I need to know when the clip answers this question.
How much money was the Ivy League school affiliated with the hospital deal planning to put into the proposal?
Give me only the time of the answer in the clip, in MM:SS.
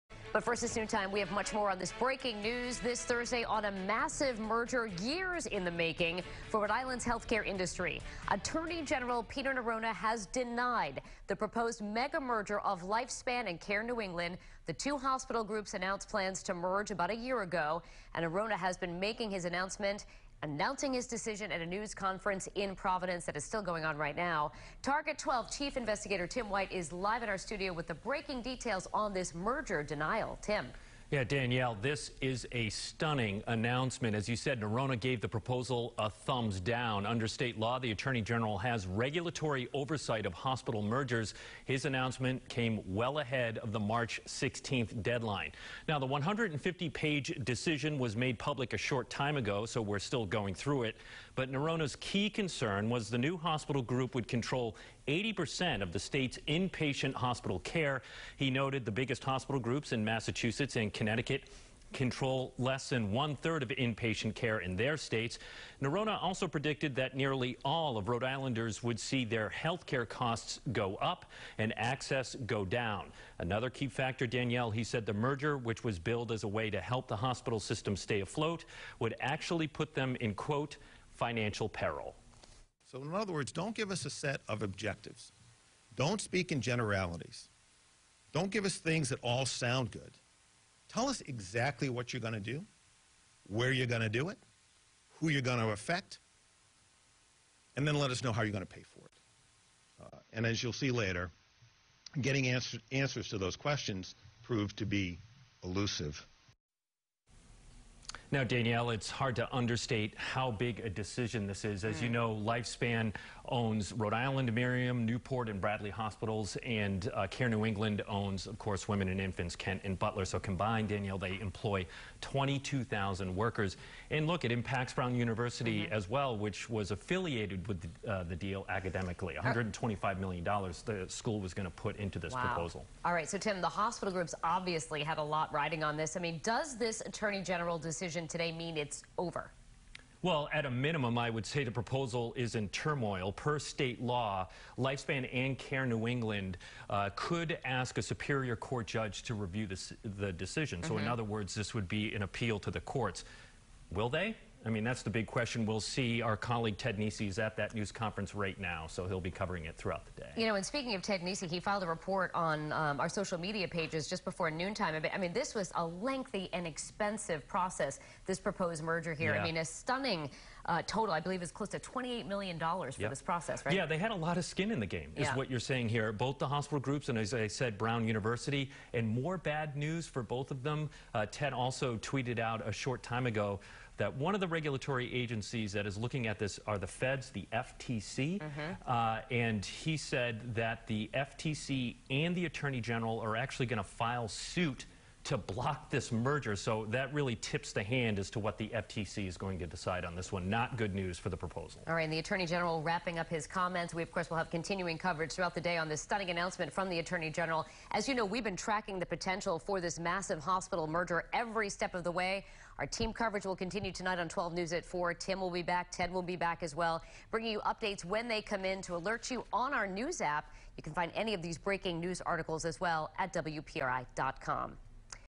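02:09.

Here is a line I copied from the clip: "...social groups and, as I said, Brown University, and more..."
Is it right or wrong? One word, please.
wrong.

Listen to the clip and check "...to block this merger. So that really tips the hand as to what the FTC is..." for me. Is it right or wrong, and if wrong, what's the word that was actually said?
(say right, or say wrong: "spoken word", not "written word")
right.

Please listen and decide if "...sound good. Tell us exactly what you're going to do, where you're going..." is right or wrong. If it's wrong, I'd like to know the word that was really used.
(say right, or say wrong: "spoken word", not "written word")
right.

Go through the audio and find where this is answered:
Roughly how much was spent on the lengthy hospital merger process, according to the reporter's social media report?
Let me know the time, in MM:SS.
02:51.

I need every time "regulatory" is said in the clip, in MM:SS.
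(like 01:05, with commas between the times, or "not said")
00:38, 03:04.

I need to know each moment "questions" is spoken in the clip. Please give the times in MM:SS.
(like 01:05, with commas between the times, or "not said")
01:43, 02:35.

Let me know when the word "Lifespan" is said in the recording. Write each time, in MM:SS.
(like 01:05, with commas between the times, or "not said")
00:12, 01:52, 02:24.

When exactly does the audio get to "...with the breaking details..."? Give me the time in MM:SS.
00:27.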